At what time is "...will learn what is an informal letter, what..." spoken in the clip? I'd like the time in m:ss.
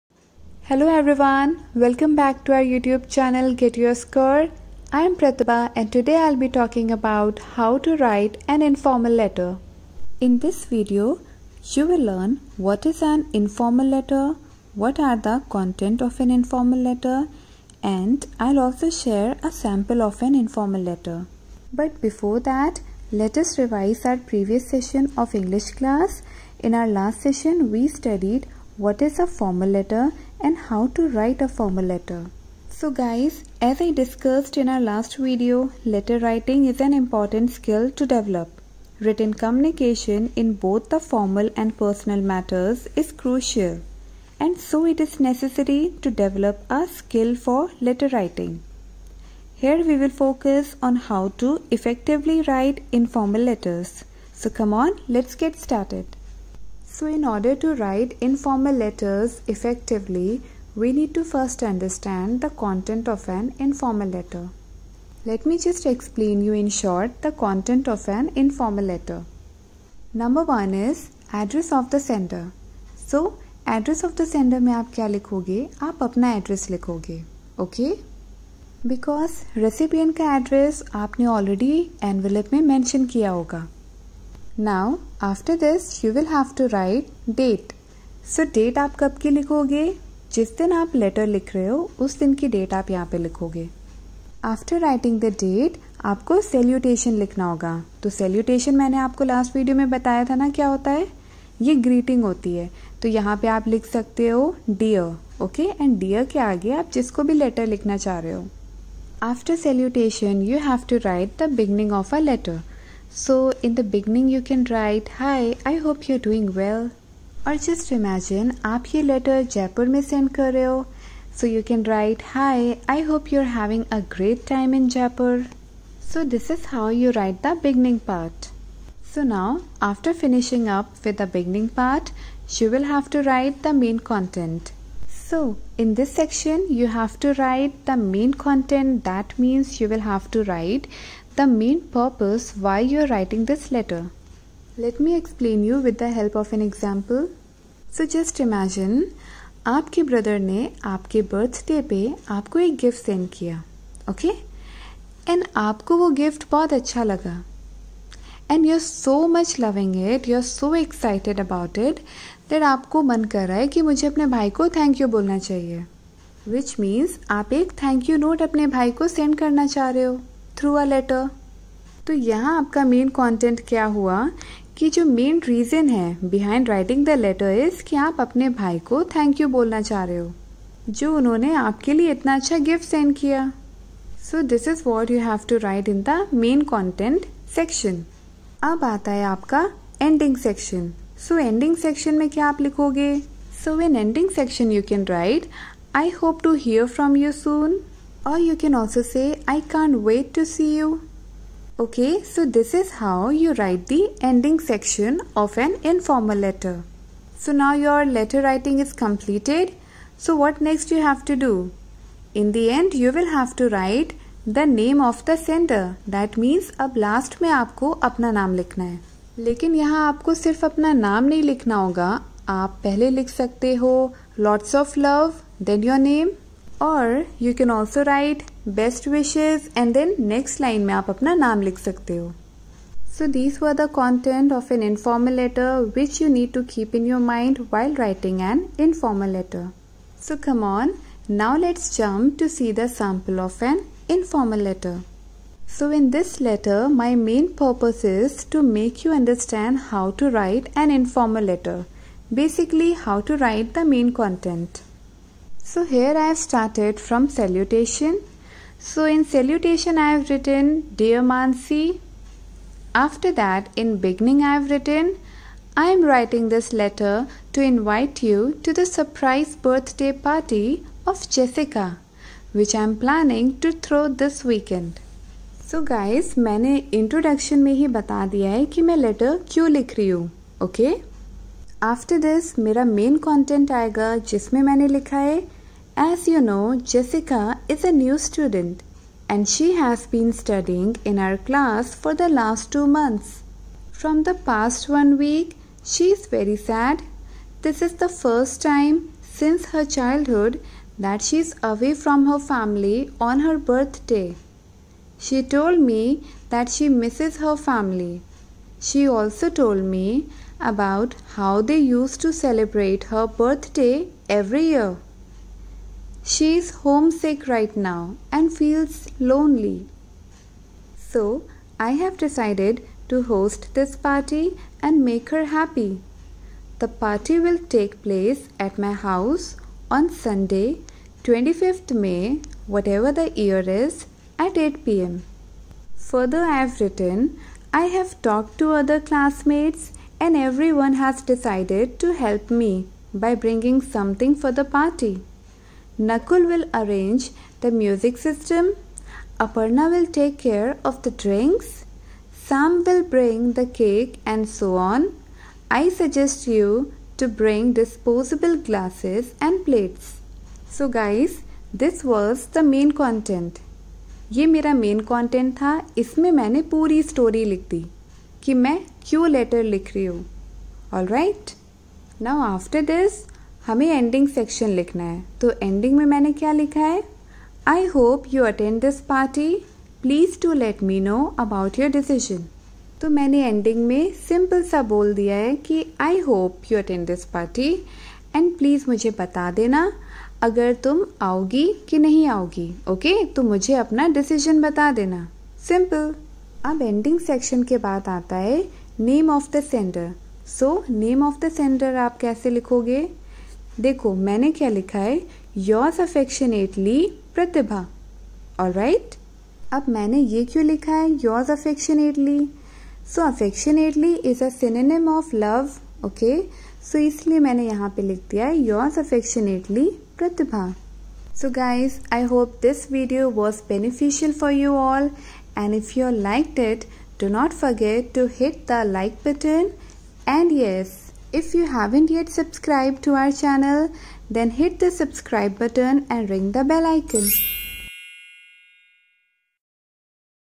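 0:11.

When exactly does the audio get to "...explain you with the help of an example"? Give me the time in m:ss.
2:25.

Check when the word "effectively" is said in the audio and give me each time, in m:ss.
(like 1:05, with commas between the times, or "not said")
0:51, 0:59.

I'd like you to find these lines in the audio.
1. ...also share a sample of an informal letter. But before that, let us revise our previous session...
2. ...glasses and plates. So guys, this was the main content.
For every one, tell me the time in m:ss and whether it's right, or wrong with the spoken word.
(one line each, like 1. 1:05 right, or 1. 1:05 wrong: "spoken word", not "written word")
1. 0:18 right
2. 5:58 right.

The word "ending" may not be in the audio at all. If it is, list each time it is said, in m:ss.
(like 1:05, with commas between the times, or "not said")
3:24.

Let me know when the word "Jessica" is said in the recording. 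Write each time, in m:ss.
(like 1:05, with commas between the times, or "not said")
4:31, 4:46.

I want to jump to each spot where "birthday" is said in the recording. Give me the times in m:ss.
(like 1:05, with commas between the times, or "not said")
4:29, 5:03, 5:13.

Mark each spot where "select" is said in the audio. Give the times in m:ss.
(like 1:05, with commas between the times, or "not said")
not said.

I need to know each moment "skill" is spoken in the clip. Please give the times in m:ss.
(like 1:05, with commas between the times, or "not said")
0:37, 0:46.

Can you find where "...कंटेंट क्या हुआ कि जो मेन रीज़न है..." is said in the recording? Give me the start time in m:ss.
2:53.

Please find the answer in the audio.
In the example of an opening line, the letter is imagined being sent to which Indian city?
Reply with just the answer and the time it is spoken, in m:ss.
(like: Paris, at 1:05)
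Jaipur, at 2:04.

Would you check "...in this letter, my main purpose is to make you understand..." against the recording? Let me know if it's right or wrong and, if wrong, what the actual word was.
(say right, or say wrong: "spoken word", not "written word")
right.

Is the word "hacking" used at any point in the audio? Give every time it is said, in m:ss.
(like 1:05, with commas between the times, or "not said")
not said.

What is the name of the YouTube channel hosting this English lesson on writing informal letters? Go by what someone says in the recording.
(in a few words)
Get Your Score.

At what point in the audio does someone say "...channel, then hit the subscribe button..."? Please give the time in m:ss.
7:13.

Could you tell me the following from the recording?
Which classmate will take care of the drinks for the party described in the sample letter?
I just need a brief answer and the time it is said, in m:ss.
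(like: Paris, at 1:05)
Aparna, at 5:49.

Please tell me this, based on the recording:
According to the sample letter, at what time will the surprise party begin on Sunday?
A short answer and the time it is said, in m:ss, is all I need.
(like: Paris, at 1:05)
8 pm, at 5:34.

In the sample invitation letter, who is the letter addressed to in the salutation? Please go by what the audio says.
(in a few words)
Mansi.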